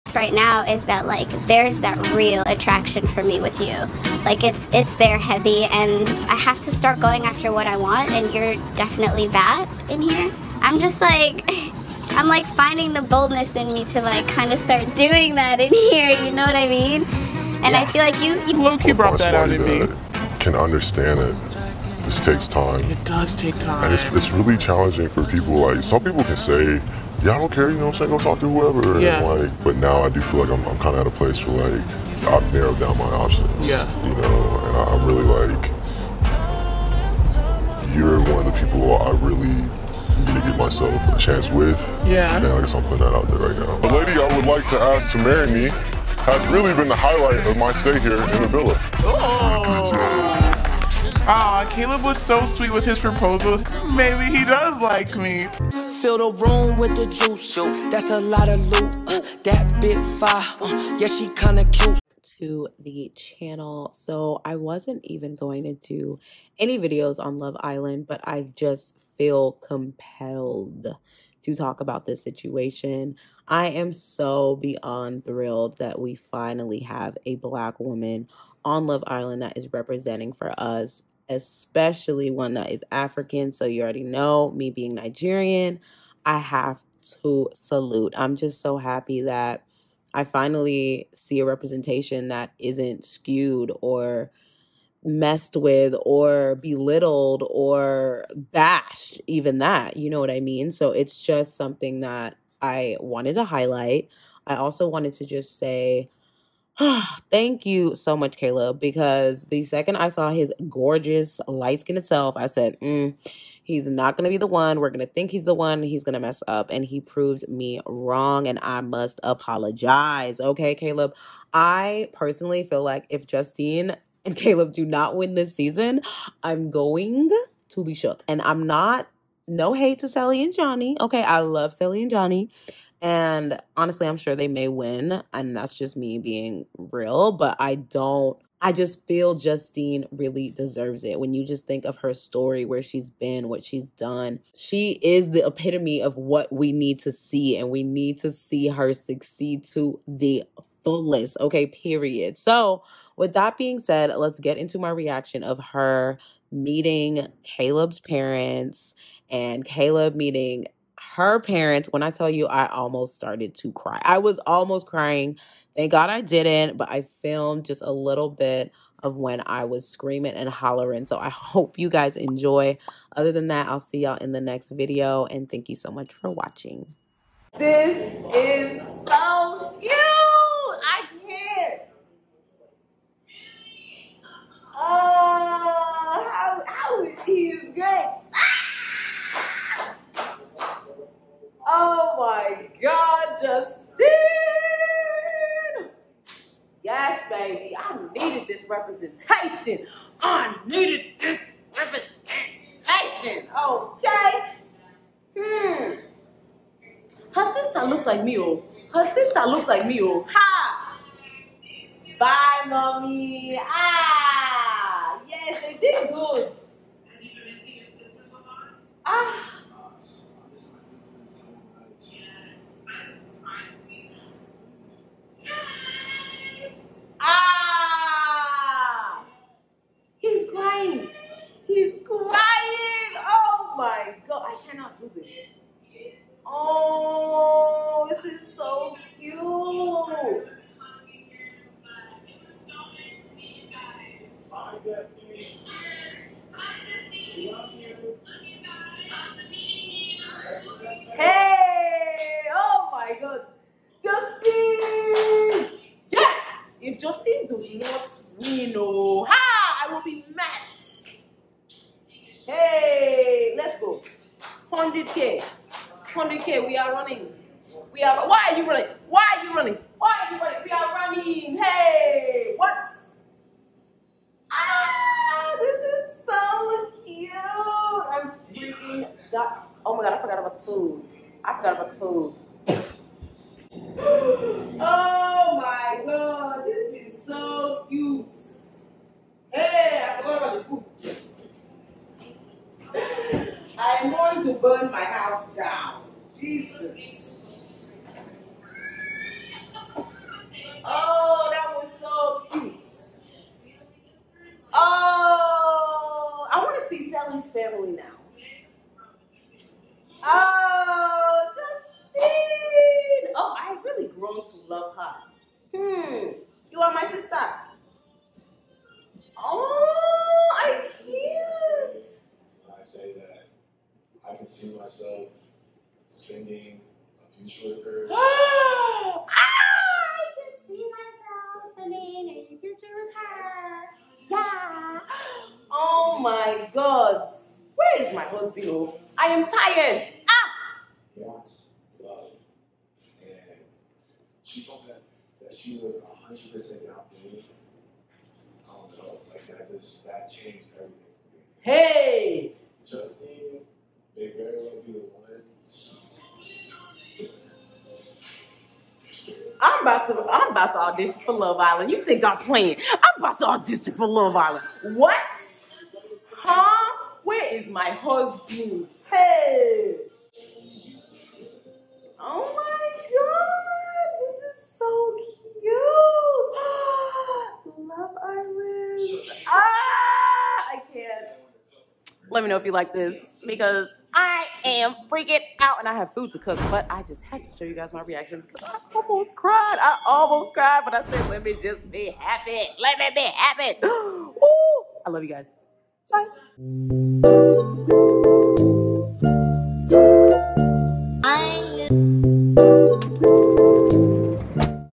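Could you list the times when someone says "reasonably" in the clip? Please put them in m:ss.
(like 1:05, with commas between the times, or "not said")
not said.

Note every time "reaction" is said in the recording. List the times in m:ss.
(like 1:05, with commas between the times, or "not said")
2:34, 6:28.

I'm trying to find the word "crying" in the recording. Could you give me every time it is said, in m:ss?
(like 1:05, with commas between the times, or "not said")
2:44.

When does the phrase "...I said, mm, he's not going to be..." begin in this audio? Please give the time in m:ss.
1:52.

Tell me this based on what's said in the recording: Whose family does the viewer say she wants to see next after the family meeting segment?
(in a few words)
Salem.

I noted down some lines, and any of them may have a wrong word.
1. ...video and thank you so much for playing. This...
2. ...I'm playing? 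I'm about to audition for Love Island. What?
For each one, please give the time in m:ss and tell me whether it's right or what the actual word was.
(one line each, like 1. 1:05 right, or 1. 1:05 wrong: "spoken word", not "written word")
1. 2:54 wrong: "watching", not "playing"
2. 6:02 right.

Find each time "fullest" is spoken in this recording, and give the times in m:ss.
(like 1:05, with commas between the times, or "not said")
2:30.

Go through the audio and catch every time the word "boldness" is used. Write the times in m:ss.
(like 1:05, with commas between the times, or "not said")
0:13.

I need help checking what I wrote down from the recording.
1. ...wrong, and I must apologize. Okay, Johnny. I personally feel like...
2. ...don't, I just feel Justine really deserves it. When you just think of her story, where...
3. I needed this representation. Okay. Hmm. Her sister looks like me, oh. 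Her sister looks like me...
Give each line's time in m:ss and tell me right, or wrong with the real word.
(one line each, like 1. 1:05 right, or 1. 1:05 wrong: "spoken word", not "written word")
1. 1:57 wrong: "Caleb", not "Johnny"
2. 2:17 right
3. 3:20 right.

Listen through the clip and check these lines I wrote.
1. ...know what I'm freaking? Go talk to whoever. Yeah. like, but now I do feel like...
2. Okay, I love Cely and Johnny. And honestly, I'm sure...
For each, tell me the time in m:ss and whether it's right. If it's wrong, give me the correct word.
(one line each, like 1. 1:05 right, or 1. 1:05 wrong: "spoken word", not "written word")
1. 0:27 wrong: "saying", not "freaking"
2. 2:10 right.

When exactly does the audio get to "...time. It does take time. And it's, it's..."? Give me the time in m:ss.
0:22.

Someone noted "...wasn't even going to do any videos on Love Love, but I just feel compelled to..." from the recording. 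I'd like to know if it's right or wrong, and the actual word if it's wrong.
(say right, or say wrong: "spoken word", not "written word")
wrong: "Island", not "Love".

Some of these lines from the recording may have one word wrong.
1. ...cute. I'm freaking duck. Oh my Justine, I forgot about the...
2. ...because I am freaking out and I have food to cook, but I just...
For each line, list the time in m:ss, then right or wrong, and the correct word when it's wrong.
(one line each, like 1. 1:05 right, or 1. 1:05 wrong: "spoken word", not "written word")
1. 4:37 wrong: "God", not "Justine"
2. 6:23 right.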